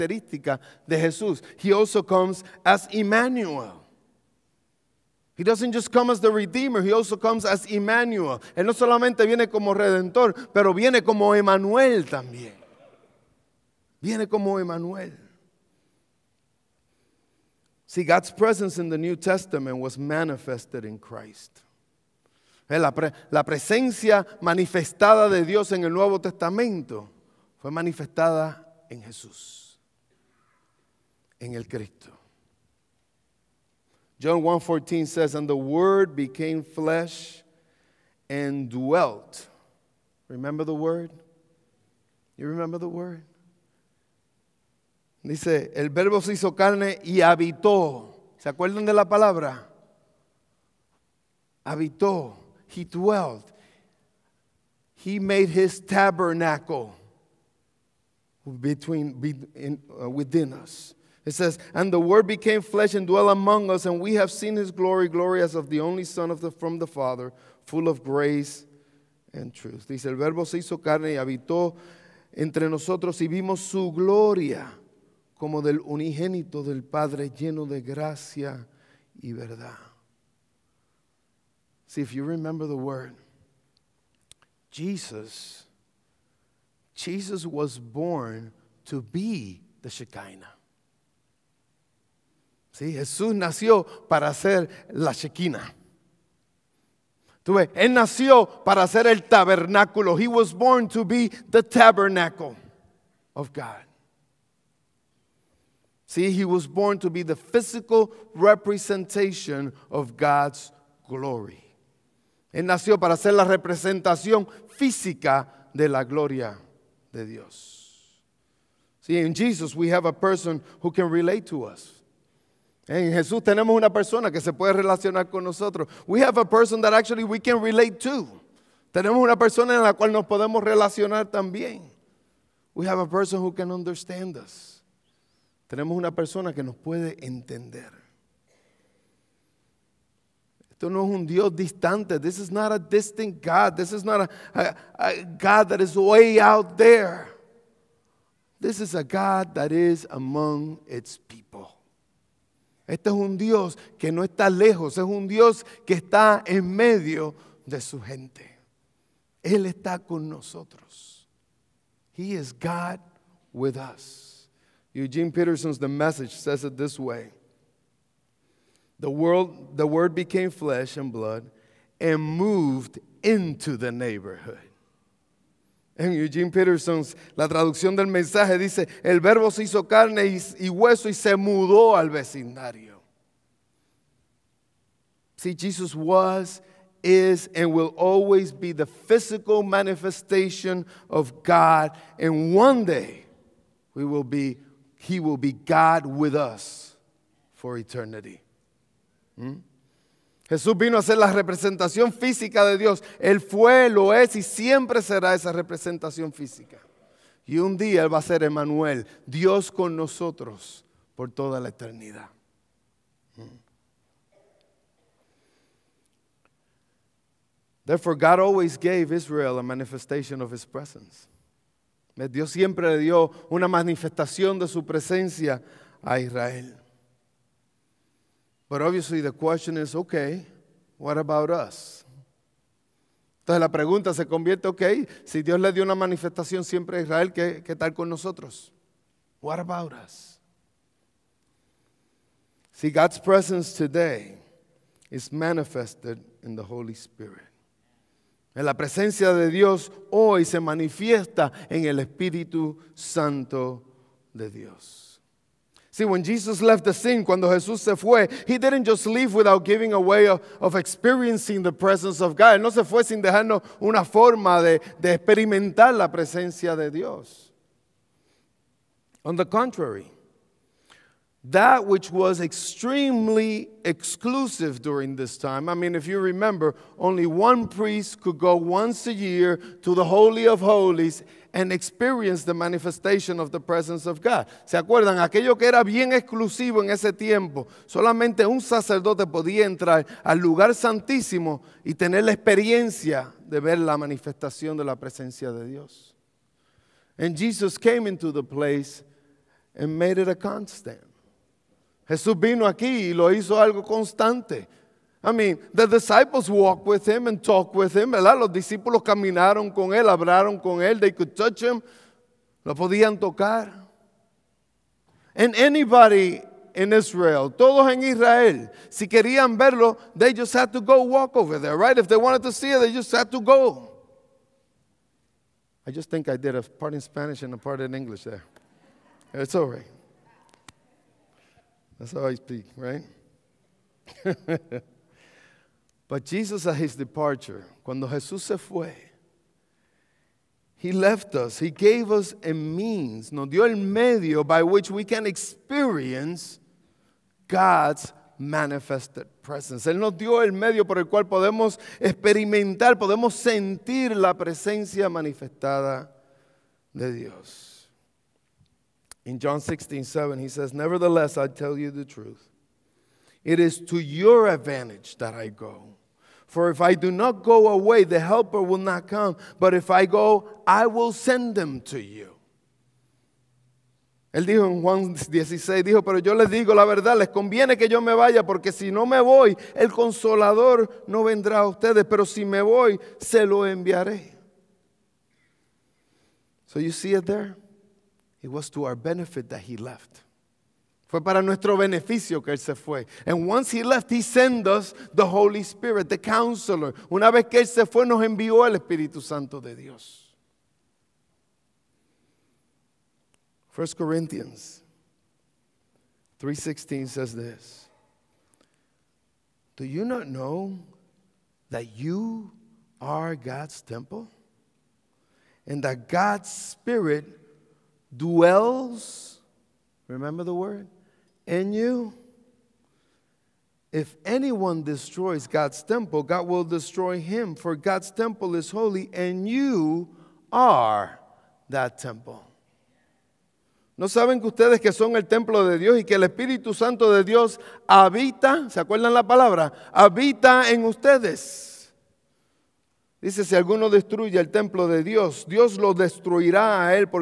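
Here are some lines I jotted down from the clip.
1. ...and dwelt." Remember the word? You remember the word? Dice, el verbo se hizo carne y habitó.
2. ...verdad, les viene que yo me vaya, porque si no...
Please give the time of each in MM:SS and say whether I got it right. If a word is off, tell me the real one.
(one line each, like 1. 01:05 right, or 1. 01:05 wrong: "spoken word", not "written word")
1. 00:38 right
2. 06:16 wrong: "conviene", not "viene".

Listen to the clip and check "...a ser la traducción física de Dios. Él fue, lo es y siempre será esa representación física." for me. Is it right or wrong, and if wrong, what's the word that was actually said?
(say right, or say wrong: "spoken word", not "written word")
wrong: "representación", not "traducción".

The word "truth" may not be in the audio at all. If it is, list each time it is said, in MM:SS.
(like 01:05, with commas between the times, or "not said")
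01:09, 06:02.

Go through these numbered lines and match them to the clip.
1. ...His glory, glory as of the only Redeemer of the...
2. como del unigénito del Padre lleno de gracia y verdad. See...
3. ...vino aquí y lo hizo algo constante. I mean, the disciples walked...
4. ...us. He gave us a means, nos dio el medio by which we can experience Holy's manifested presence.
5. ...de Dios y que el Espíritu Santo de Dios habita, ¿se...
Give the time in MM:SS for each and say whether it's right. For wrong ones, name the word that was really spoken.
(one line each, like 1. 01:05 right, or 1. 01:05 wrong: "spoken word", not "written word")
1. 01:04 wrong: "Son", not "Redeemer"
2. 01:15 right
3. 05:02 right
4. 05:41 wrong: "God", not "Holy"
5. 07:15 right.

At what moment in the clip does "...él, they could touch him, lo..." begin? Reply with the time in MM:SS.
05:10.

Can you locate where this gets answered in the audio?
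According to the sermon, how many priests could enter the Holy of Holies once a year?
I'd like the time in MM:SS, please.
04:36.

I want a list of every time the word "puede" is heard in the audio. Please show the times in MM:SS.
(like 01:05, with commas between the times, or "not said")
02:04, 02:16.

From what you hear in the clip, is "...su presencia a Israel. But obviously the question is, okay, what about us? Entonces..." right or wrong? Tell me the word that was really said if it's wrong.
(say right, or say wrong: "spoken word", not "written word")
right.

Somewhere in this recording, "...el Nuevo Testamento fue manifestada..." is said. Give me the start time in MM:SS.
00:25.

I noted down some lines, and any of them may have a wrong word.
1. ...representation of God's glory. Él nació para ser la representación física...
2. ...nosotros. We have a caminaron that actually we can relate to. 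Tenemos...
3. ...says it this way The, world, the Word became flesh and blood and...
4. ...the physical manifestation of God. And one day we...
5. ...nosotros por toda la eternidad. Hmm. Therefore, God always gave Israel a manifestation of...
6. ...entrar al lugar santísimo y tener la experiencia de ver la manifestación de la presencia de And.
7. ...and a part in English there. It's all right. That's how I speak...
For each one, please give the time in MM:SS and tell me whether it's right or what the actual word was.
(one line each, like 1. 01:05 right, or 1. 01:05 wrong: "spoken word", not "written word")
1. 01:48 right
2. 02:05 wrong: "person", not "caminaron"
3. 02:46 right
4. 03:08 right
5. 03:29 right
6. 04:49 wrong: "Dios", not "And"
7. 05:27 right.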